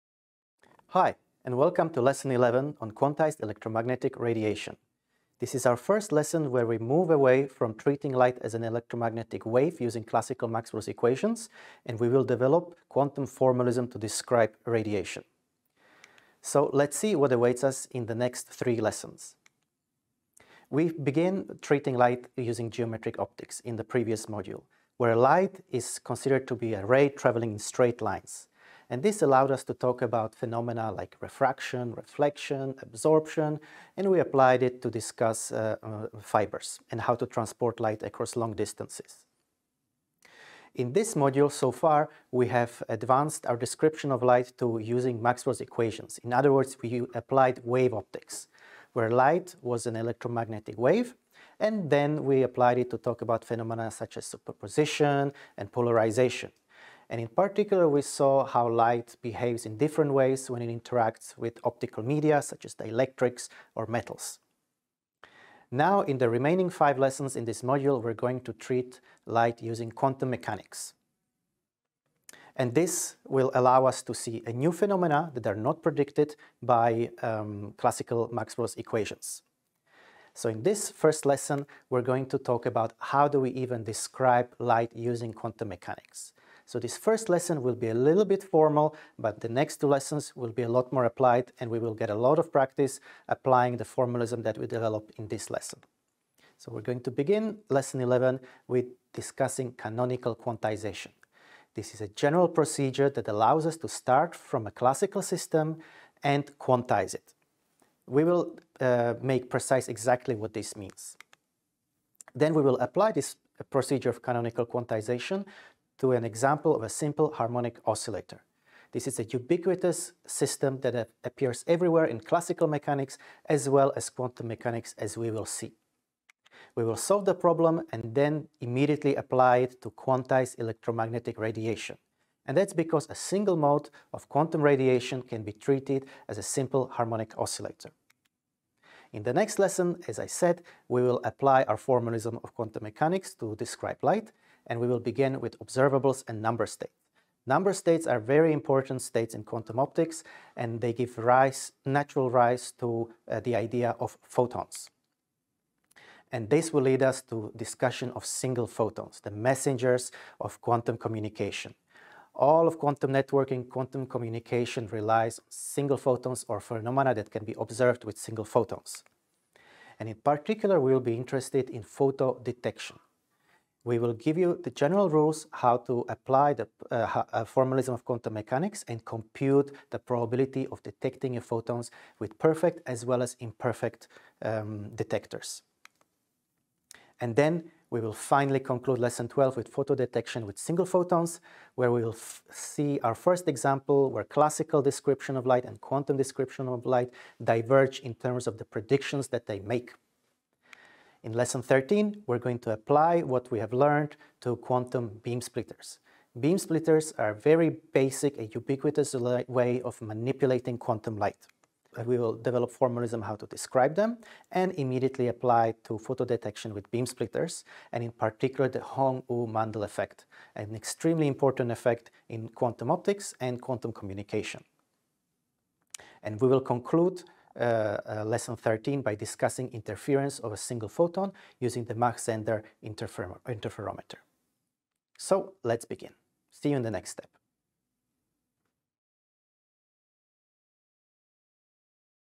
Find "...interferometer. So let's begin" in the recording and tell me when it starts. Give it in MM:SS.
03:53.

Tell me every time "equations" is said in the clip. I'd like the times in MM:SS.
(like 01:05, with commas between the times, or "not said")
00:10, 00:45, 01:18.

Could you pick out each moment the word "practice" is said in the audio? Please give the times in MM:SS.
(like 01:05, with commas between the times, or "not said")
01:32.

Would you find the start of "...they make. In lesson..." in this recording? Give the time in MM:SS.
03:19.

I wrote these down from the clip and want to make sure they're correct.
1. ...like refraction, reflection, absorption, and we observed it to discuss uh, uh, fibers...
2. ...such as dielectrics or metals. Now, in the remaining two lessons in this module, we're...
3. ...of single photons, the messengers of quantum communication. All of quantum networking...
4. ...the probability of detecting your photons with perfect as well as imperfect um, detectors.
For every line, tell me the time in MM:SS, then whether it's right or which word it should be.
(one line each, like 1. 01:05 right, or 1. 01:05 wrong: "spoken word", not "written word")
1. 00:30 wrong: "applied", not "observed"
2. 01:02 wrong: "five", not "two"
3. 02:38 right
4. 02:59 right.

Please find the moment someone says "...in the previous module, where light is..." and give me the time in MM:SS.
00:23.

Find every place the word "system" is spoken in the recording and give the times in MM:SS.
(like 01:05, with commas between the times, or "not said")
01:45, 02:00.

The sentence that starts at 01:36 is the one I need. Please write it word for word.
So we're going to begin lesson 11 with discussing canonical quantization.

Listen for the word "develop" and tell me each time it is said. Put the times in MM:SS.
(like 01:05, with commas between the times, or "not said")
00:12, 01:34, 03:32.